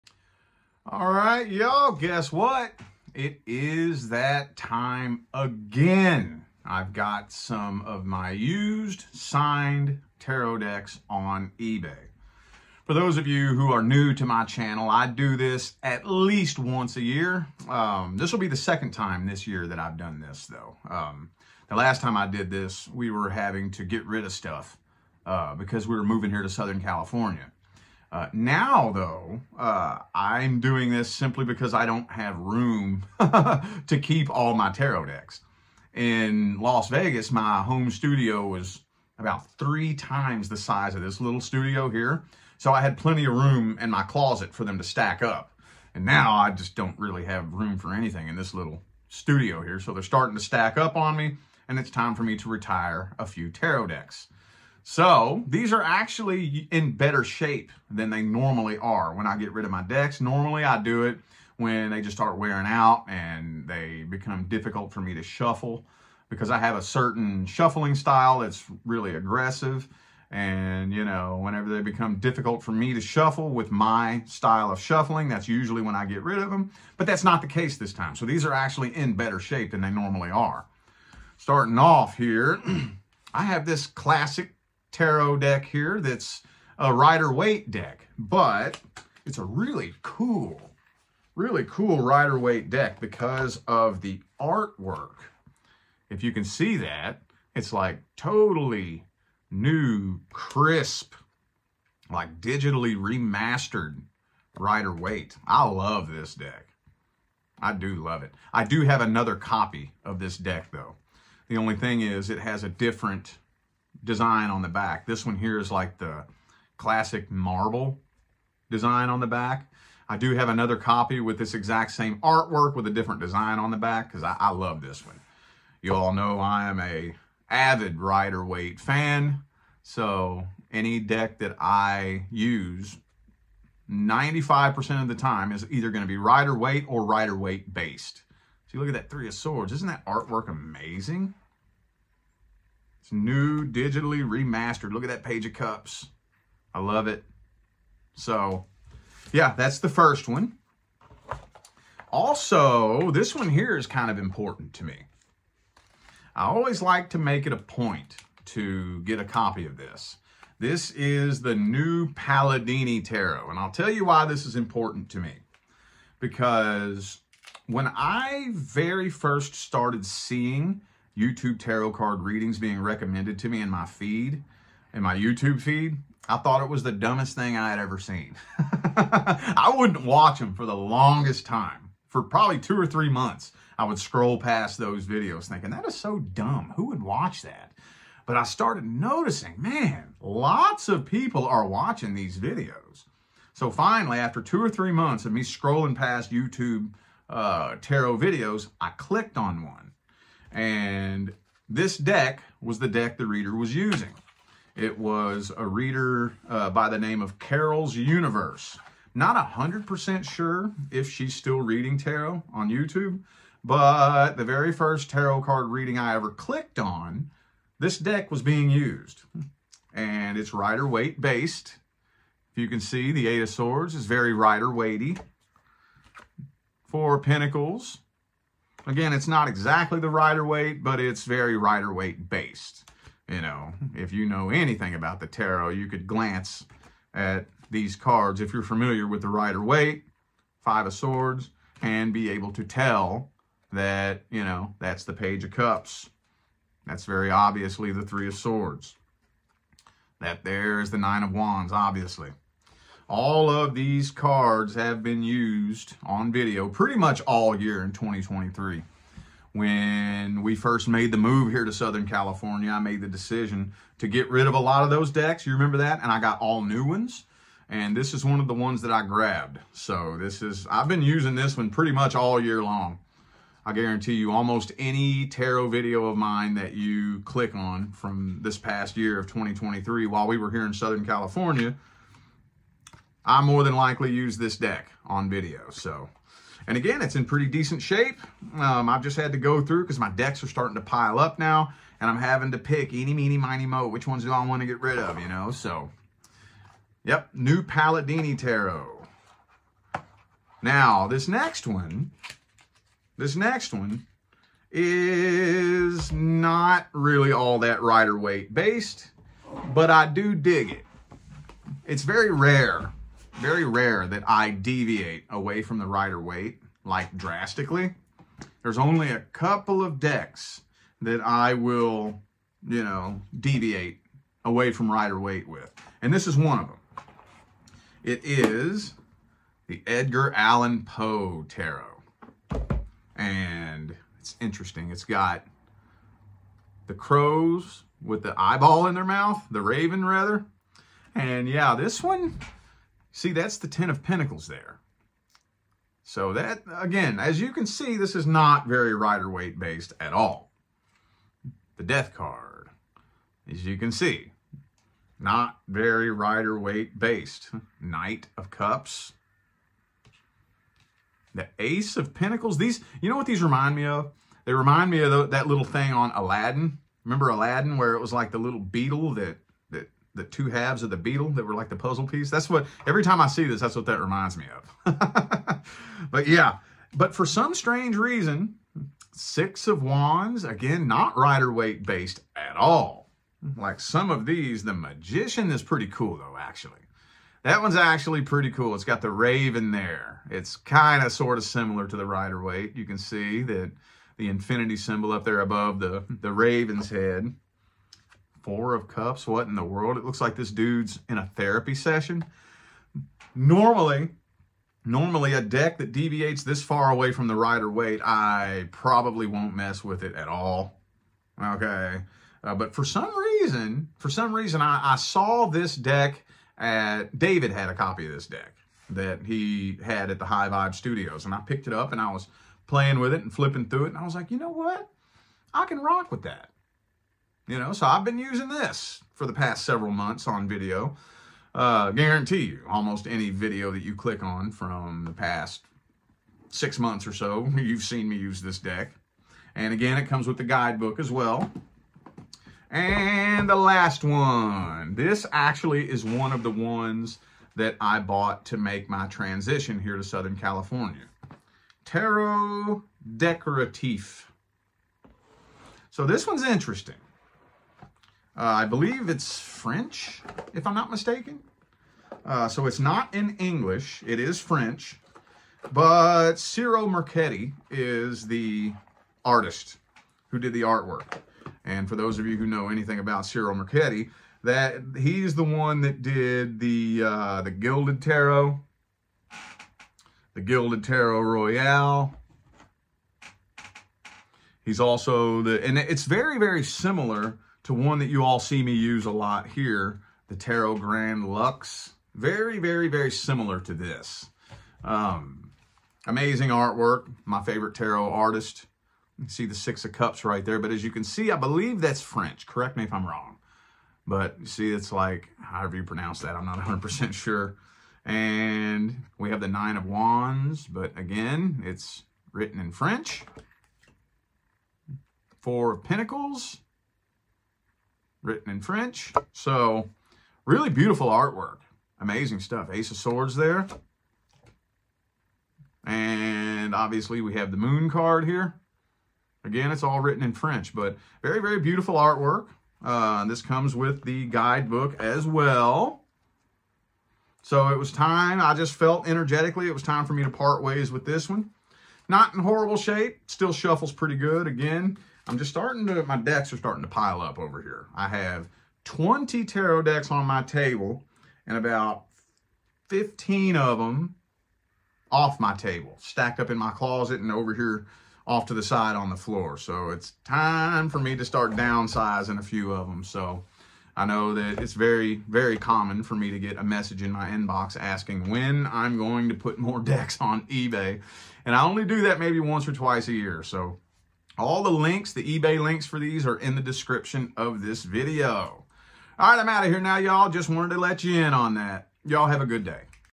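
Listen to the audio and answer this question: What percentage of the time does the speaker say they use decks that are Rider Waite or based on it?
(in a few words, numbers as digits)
95%.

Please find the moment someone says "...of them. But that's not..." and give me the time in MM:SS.
01:16.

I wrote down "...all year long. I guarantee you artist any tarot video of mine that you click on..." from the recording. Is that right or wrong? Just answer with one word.
wrong.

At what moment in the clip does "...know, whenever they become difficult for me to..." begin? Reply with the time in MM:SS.
01:11.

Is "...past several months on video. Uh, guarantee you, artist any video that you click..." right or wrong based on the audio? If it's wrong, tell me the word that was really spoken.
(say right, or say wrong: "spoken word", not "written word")
wrong: "almost", not "artist".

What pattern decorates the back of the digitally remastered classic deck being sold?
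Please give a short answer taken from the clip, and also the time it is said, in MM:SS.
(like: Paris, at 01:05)
marble, at 01:57.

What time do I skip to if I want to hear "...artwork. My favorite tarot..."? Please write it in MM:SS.
08:16.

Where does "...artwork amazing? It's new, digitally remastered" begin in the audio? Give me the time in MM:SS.
02:20.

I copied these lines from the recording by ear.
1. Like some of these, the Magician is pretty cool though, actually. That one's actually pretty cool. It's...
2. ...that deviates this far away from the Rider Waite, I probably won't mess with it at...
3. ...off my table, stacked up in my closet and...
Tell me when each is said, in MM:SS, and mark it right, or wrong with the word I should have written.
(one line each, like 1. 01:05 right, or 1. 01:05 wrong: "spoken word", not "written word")
1. 06:23 right
2. 06:45 right
3. 09:15 right.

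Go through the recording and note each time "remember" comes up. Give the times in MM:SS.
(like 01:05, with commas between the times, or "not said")
04:25, 06:07.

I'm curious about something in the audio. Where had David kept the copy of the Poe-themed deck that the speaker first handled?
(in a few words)
High Vibe Studios.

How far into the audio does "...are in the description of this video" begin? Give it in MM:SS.
09:36.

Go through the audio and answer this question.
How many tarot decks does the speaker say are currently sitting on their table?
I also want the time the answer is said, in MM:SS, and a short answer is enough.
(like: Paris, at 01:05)
20, at 09:08.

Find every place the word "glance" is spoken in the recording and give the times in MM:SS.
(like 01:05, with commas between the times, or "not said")
03:56.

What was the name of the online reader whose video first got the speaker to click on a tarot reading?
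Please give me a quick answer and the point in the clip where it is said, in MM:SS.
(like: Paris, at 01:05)
Carol's Universe, at 03:27.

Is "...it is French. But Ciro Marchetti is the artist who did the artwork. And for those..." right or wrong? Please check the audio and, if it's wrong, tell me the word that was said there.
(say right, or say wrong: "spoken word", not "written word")
right.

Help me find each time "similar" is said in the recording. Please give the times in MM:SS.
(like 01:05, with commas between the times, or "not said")
06:31, 08:06, 08:13.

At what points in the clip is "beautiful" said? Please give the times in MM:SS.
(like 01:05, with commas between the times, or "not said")
08:40, 08:51.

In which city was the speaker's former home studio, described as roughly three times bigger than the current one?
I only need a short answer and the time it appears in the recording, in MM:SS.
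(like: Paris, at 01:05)
Las Vegas, at 00:36.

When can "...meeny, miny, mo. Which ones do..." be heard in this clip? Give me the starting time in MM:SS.
04:53.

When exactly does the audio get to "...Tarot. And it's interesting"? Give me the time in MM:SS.
05:31.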